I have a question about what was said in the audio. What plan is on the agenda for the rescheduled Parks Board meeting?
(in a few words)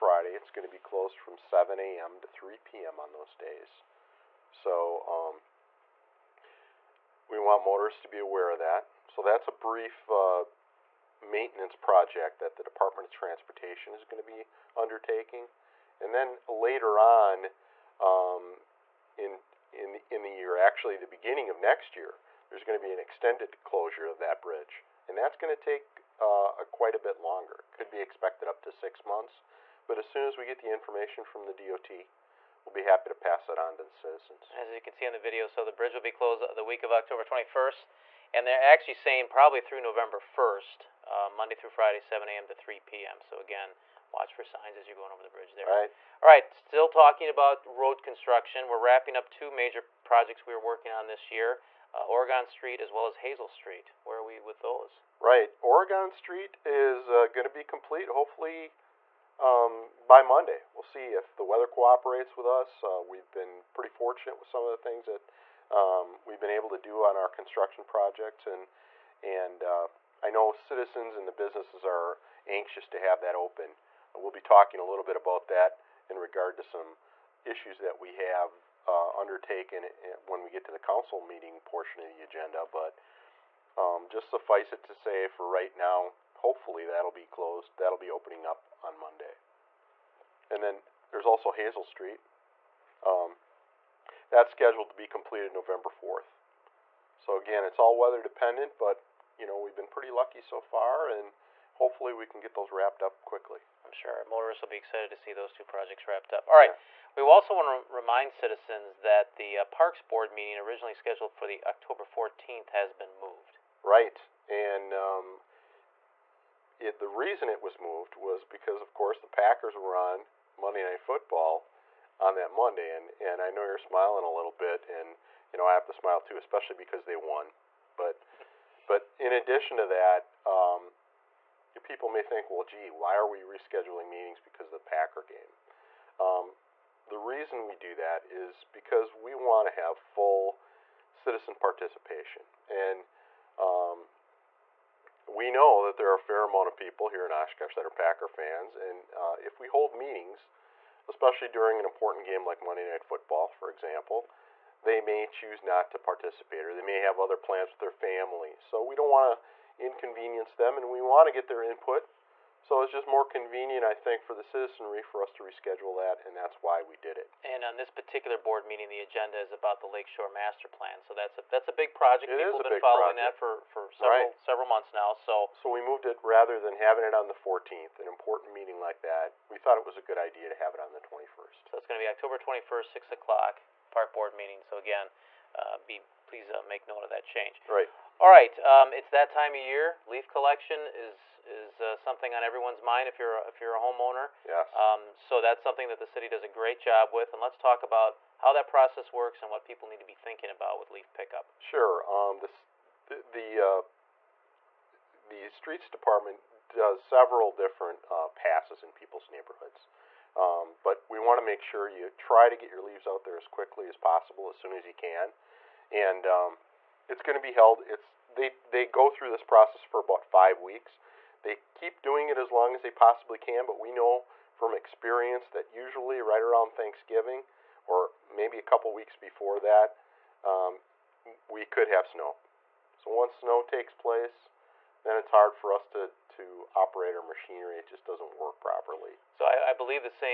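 Lakeshore Master Plan.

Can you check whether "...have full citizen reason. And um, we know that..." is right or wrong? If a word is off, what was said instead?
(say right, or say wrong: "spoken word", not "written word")
wrong: "participation", not "reason".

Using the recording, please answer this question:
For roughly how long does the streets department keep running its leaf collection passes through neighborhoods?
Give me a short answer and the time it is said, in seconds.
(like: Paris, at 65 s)
About 5 weeks, at 220 s.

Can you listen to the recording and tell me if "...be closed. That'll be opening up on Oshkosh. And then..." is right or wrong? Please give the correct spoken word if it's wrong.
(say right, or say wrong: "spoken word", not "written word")
wrong: "Monday", not "Oshkosh".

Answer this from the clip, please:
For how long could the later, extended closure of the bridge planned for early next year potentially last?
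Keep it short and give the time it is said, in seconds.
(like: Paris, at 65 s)
6 months, at 28 s.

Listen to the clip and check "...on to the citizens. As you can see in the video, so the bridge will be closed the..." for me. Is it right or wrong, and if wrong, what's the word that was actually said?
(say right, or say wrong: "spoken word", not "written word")
right.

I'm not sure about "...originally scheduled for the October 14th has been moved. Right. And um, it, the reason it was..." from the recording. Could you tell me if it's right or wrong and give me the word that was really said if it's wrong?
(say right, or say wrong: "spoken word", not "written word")
right.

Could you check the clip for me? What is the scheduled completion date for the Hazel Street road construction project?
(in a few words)
November 4th.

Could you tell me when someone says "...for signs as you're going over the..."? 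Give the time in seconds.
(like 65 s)
44 s.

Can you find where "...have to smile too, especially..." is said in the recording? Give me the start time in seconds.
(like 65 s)
125 s.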